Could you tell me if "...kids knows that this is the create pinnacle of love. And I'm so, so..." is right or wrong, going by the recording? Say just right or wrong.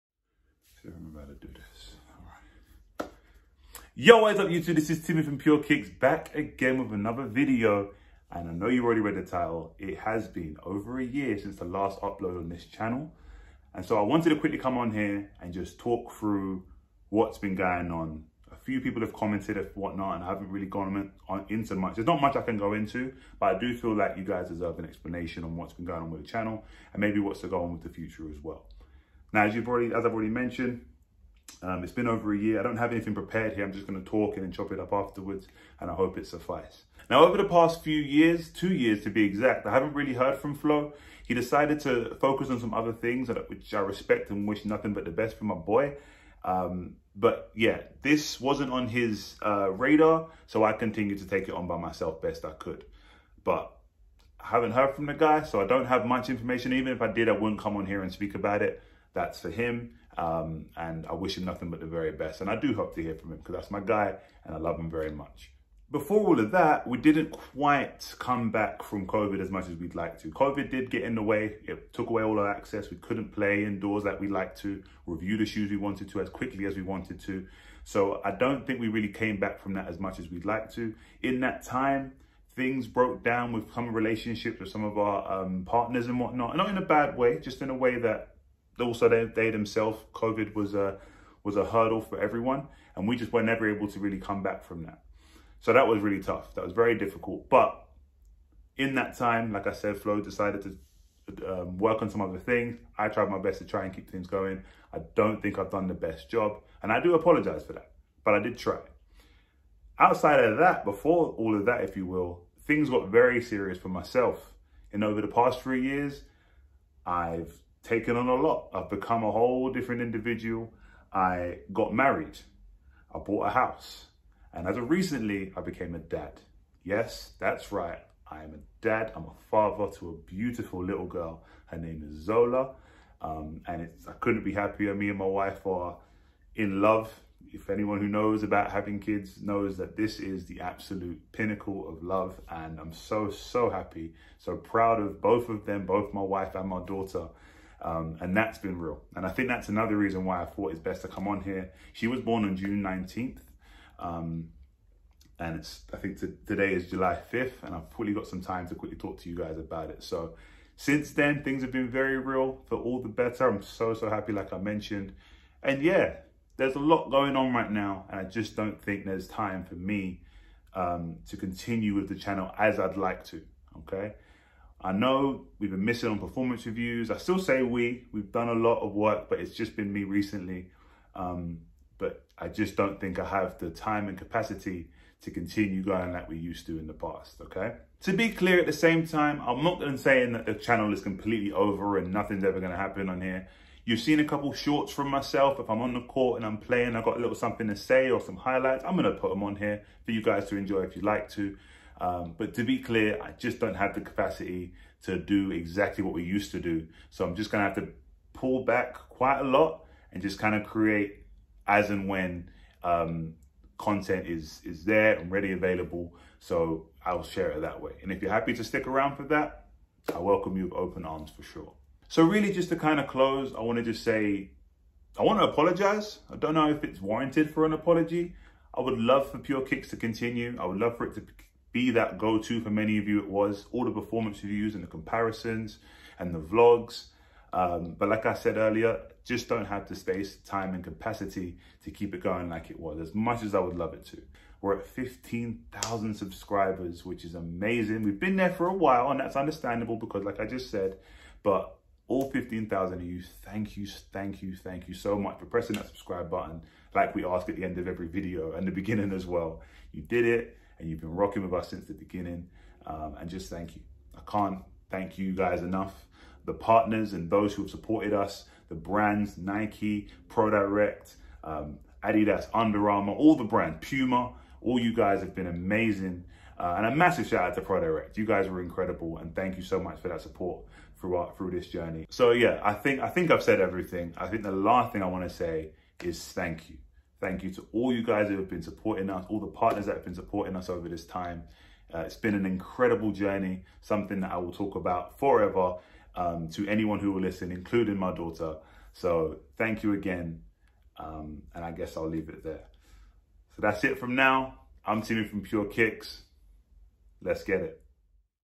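wrong.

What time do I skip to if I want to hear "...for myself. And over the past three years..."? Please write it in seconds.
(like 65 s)
113 s.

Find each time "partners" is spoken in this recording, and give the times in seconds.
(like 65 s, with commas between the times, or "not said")
85 s, 266 s, 289 s.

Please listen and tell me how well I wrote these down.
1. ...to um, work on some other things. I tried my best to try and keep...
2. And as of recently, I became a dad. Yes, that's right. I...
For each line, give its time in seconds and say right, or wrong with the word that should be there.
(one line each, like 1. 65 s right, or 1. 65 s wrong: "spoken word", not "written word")
1. 100 s right
2. 124 s right.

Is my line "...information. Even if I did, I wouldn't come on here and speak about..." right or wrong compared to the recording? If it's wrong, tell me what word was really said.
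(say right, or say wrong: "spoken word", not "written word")
right.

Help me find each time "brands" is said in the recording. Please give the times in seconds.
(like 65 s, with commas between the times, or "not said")
268 s, 273 s.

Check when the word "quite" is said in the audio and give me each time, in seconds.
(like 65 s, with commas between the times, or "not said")
67 s, 209 s.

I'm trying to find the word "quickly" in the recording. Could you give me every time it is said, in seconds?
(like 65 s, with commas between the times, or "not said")
14 s, 76 s, 158 s.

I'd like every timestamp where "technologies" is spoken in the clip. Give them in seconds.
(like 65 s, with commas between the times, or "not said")
not said.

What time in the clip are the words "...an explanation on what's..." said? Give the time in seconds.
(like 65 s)
24 s.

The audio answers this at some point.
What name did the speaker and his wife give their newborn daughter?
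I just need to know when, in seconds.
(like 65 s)
132 s.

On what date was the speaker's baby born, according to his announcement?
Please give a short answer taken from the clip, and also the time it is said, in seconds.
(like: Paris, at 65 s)
June 19th, at 152 s.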